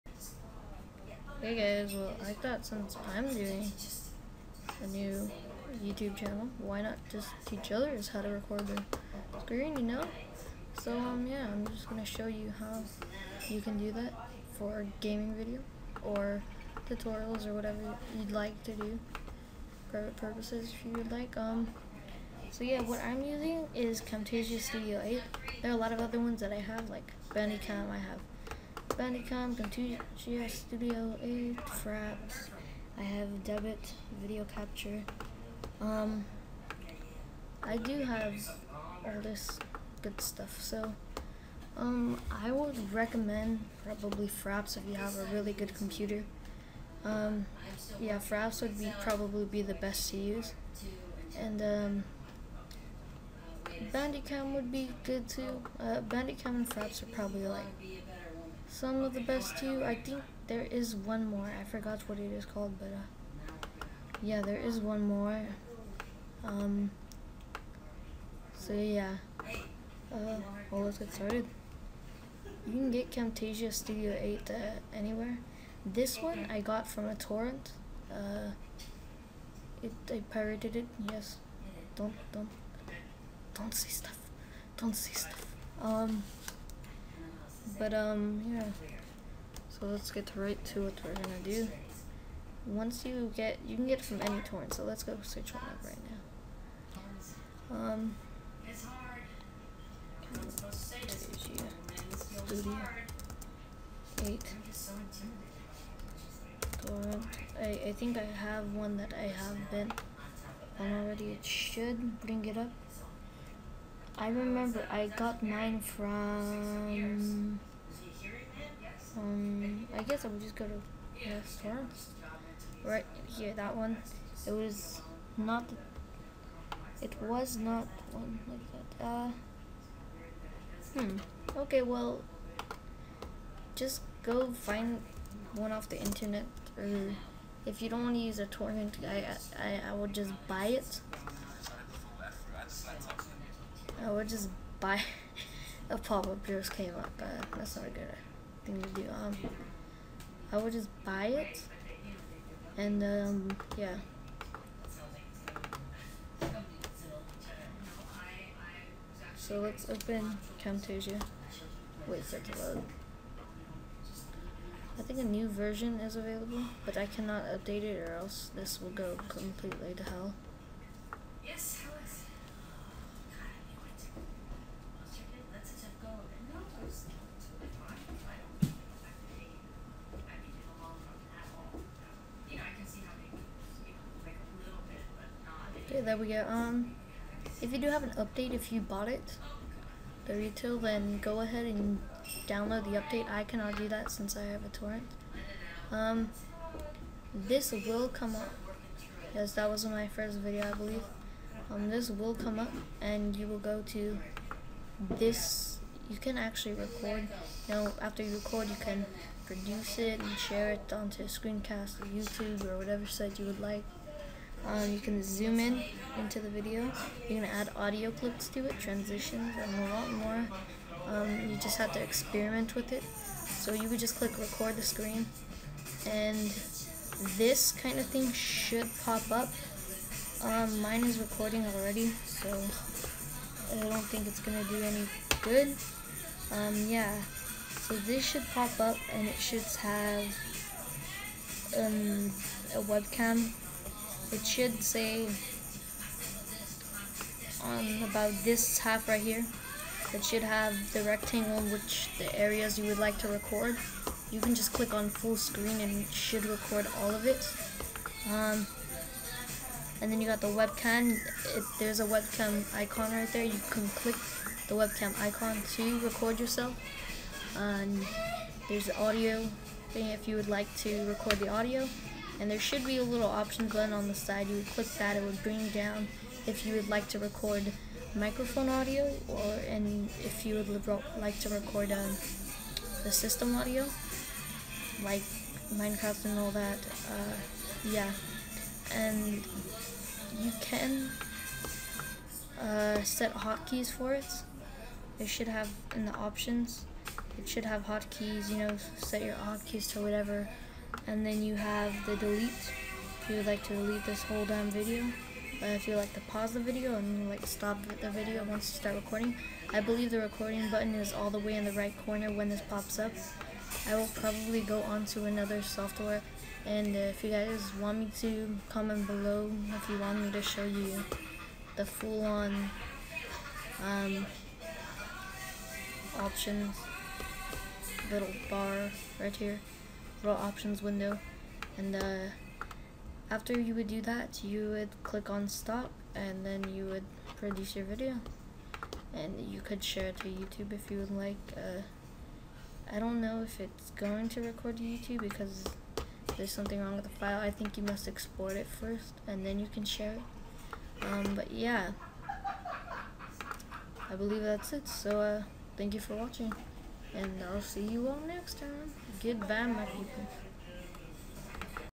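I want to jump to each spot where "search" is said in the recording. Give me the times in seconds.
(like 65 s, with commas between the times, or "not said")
95 s.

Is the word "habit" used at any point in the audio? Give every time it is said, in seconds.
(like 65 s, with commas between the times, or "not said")
not said.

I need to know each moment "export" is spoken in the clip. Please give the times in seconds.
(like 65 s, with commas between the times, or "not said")
348 s.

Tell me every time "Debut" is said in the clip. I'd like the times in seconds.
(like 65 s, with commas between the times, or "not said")
33 s.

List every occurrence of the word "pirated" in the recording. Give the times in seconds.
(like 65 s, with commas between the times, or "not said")
80 s.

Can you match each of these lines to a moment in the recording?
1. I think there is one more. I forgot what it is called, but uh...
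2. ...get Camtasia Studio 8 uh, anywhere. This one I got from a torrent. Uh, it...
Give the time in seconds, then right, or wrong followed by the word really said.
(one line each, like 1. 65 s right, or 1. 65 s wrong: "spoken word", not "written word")
1. 59 s right
2. 72 s right.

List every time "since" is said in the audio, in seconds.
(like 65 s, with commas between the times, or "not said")
2 s, 194 s.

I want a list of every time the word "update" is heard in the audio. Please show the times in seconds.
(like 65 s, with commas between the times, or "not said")
167 s, 188 s, 192 s.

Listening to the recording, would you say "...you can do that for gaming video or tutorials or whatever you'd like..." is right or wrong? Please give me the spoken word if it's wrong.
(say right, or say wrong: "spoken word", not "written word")
right.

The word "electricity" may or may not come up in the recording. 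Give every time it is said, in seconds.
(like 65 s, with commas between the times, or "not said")
not said.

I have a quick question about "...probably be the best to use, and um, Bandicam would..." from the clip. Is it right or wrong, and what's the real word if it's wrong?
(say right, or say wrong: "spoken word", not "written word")
right.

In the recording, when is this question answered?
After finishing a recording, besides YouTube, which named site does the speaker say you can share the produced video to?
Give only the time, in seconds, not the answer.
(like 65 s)
211 s.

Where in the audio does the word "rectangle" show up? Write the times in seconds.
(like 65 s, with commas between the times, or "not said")
251 s.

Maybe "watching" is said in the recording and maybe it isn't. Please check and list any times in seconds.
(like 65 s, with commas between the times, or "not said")
356 s.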